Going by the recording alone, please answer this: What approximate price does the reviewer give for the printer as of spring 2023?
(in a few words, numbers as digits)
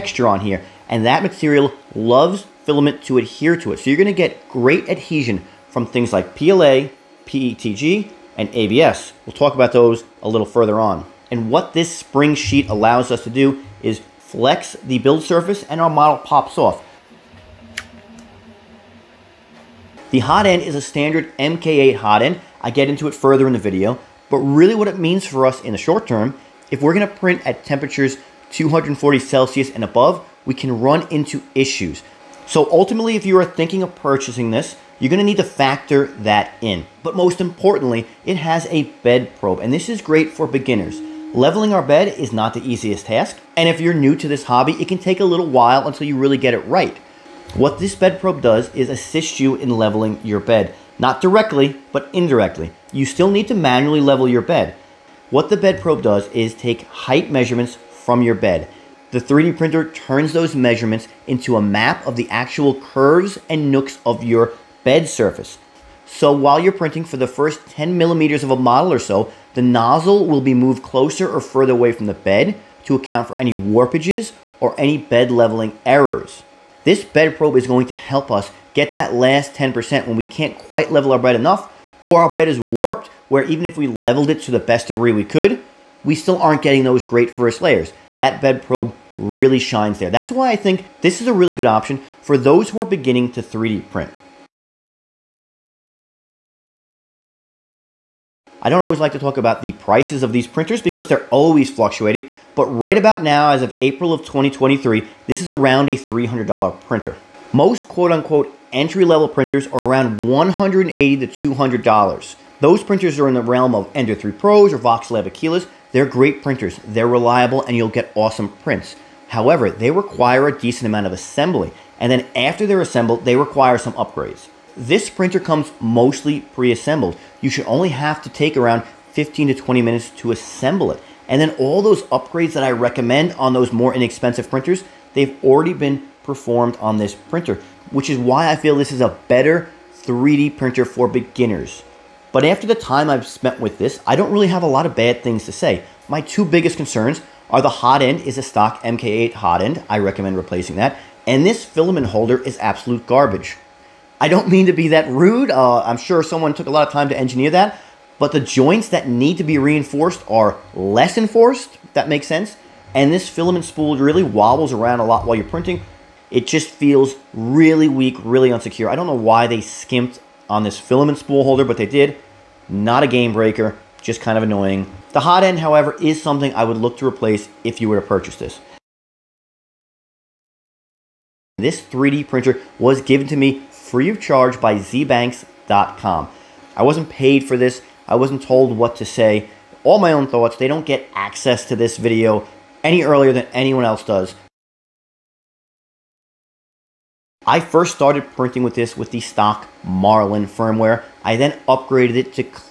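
$300.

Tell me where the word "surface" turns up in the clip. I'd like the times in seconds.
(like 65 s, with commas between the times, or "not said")
15 s, 65 s.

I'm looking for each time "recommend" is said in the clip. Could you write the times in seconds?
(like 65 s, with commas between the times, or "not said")
132 s, 149 s.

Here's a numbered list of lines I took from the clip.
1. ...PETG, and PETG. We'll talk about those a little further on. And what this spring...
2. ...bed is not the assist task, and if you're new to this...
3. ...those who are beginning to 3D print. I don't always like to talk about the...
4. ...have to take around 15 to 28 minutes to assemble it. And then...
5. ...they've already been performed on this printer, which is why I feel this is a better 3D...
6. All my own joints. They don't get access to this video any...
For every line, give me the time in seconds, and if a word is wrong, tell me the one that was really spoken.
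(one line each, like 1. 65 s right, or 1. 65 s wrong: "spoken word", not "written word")
1. 7 s wrong: "ABS", not "PETG"
2. 41 s wrong: "easiest", not "assist"
3. 92 s right
4. 127 s wrong: "20", not "28"
5. 135 s right
6. 189 s wrong: "thoughts", not "joints".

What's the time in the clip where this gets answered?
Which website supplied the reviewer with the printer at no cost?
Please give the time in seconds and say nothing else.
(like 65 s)
184 s.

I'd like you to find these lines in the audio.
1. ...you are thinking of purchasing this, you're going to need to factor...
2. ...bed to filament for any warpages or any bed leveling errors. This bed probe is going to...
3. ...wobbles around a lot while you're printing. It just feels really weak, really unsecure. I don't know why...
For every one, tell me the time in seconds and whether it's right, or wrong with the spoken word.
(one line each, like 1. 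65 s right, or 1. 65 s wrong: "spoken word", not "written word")
1. 33 s right
2. 72 s wrong: "account", not "filament"
3. 164 s right.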